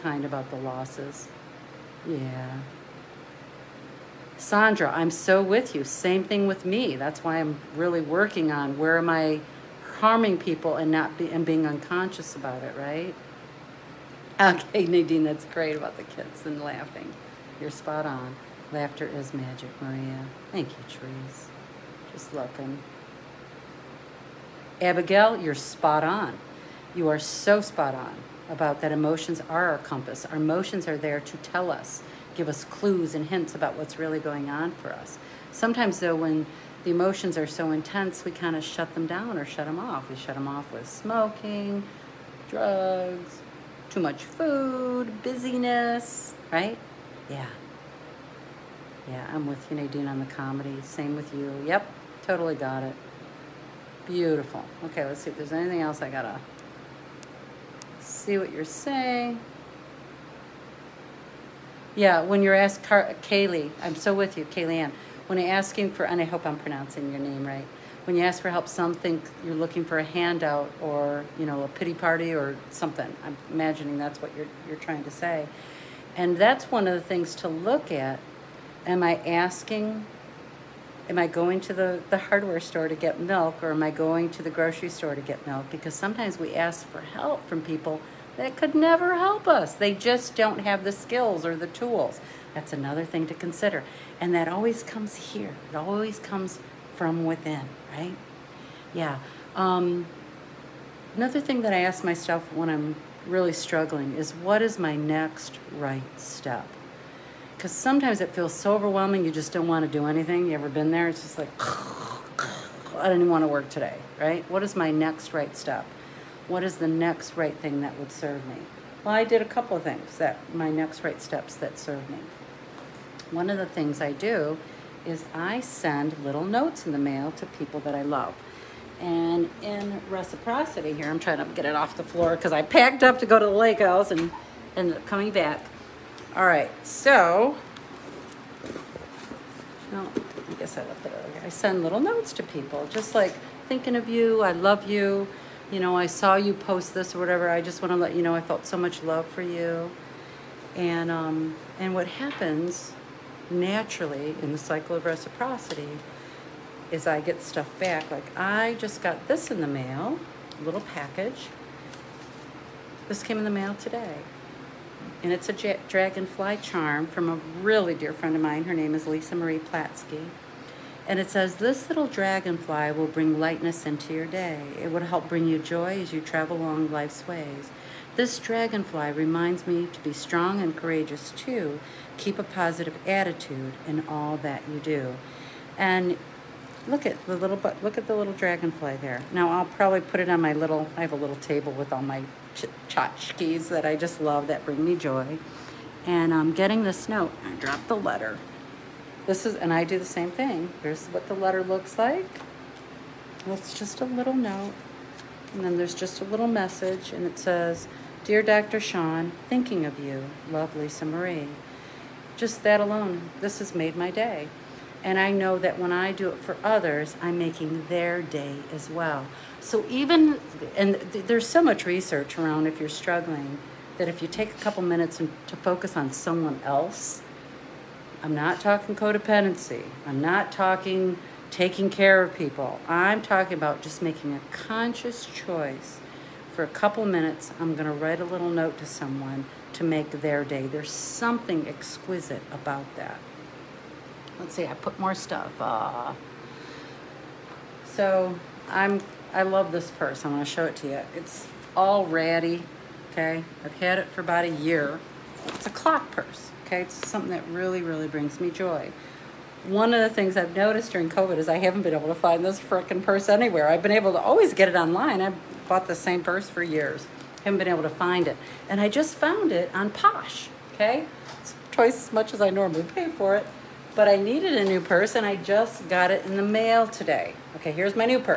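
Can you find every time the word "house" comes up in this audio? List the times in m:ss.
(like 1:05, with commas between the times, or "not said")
2:13.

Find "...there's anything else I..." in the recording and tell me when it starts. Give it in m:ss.
0:55.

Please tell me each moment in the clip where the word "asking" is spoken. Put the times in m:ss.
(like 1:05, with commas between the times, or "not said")
1:05, 1:19.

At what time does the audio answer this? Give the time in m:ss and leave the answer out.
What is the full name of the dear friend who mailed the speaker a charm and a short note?
2:49.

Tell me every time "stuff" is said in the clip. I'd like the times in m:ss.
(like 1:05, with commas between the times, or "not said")
2:37, 4:05.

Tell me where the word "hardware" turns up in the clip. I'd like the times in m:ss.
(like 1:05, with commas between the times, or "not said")
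1:22.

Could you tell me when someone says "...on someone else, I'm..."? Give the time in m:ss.
3:45.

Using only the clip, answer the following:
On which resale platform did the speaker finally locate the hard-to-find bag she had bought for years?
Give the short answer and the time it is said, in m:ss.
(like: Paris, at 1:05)
Posh, at 4:29.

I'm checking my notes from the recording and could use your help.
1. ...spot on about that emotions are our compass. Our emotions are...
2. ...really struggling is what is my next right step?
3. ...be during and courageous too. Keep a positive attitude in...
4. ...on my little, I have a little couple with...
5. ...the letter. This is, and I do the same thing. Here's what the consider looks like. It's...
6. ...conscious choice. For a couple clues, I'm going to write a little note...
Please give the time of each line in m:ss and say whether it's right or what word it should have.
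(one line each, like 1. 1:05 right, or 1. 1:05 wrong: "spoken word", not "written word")
1. 0:27 right
2. 1:43 right
3. 2:59 wrong: "strong", not "during"
4. 3:10 wrong: "table", not "couple"
5. 3:17 wrong: "letter", not "consider"
6. 3:54 wrong: "minutes", not "clues".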